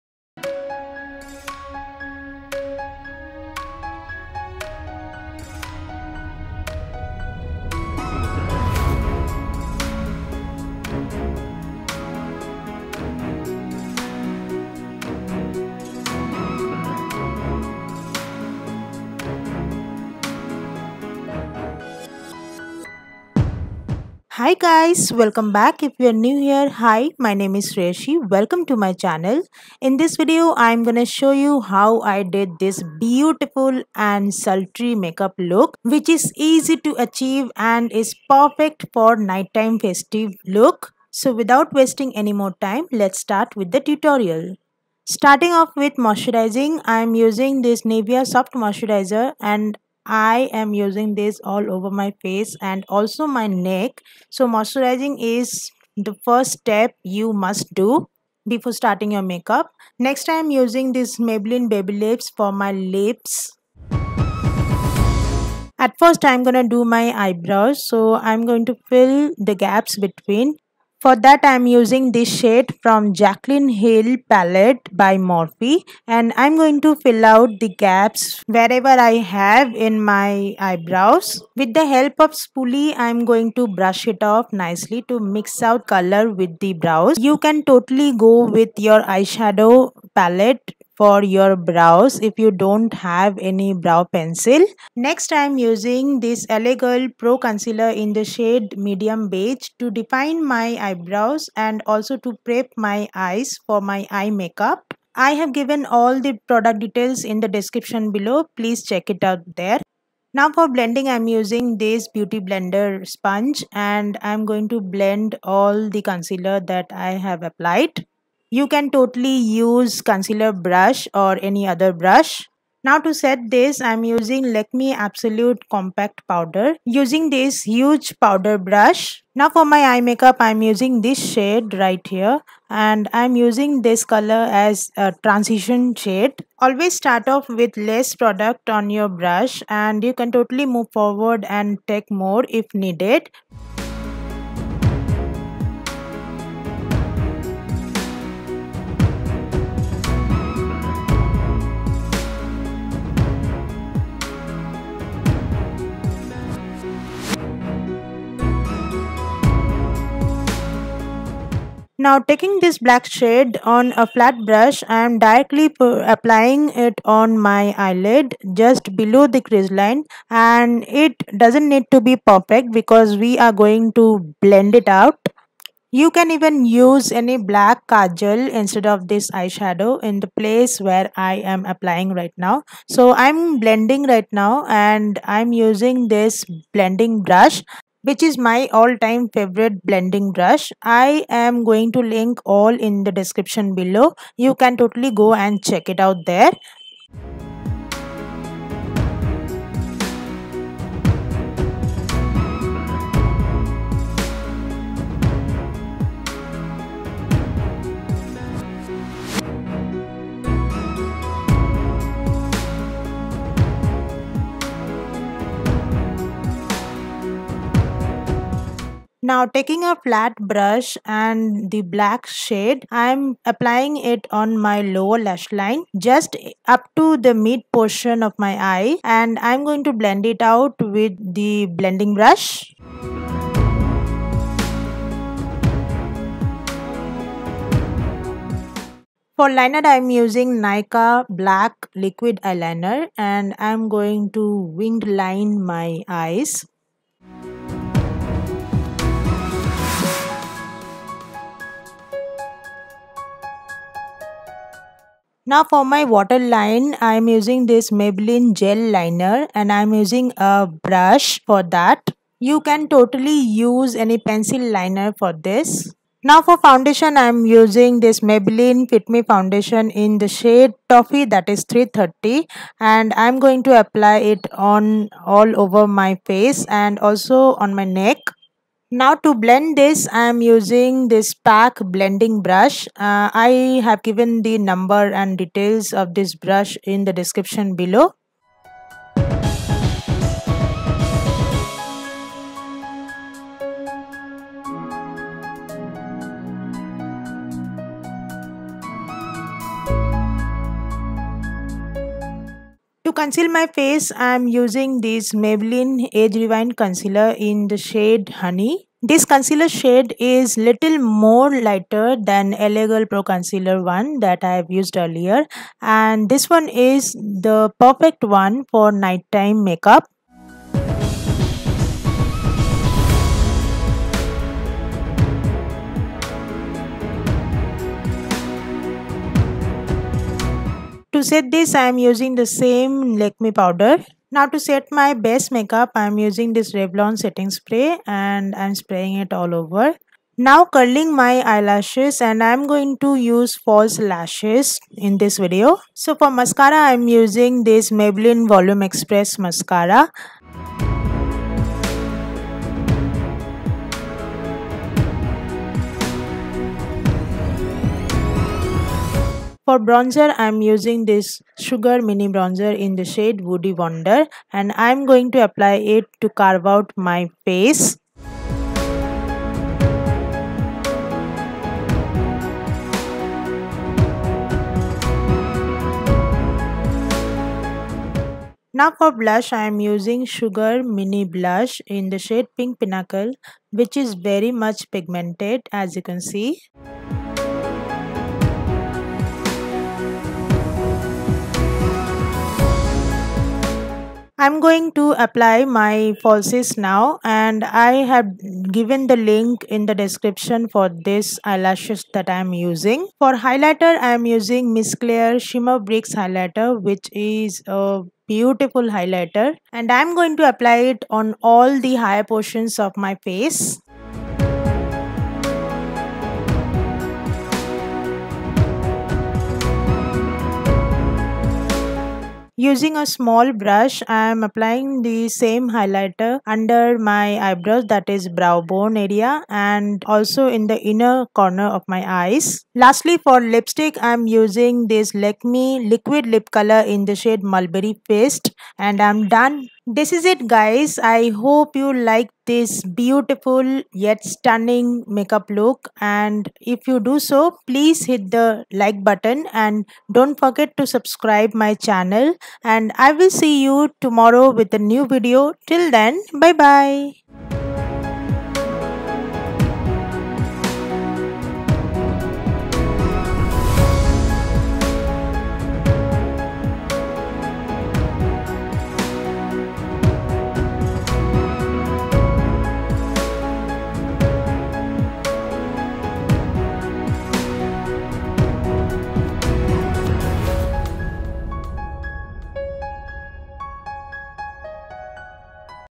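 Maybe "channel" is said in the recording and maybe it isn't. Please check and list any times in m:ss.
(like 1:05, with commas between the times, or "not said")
0:28, 7:31.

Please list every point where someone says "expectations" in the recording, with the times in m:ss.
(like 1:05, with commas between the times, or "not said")
not said.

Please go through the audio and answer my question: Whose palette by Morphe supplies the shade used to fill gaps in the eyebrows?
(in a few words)
Jaclyn Hill.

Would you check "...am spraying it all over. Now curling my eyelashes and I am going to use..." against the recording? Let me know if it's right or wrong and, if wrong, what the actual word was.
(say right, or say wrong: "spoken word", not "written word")
right.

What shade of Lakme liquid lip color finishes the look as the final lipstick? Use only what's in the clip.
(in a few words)
Mulberry Paste.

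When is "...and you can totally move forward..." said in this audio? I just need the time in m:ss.
2:19.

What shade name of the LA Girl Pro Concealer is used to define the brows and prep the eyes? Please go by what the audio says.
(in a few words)
medium beige.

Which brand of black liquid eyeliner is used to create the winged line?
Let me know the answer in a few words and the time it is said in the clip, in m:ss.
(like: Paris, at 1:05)
Nykaa, at 4:00.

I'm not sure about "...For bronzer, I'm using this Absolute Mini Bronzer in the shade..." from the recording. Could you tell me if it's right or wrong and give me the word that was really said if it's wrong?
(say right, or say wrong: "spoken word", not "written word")
wrong: "Sugar", not "Absolute".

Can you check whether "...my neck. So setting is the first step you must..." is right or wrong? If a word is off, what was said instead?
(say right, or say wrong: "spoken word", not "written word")
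wrong: "moisturizing", not "setting".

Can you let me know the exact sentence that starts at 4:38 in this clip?
Now to blend this, I am using this pack blending brush.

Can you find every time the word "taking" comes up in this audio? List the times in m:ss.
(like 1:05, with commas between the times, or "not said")
2:42, 3:39.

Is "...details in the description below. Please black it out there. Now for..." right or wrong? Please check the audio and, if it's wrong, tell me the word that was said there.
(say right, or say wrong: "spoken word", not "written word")
wrong: "check", not "black".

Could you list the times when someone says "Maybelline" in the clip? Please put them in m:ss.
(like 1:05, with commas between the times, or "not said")
1:01, 4:17, 4:28, 5:05, 5:48.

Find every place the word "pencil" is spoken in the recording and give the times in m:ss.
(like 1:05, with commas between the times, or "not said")
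1:34, 4:24.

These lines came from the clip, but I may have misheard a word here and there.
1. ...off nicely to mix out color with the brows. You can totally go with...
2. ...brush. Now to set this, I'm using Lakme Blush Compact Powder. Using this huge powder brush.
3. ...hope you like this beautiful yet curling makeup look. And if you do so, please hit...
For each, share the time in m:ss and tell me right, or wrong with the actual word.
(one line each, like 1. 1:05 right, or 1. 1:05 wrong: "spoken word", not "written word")
1. 1:24 right
2. 2:01 wrong: "Absolute", not "Blush"
3. 7:21 wrong: "stunning", not "curling".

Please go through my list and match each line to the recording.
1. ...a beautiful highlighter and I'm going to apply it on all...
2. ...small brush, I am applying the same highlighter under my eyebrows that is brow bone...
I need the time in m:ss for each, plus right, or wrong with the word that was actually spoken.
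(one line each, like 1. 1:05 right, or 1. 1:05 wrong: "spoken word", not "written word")
1. 6:47 right
2. 7:03 right.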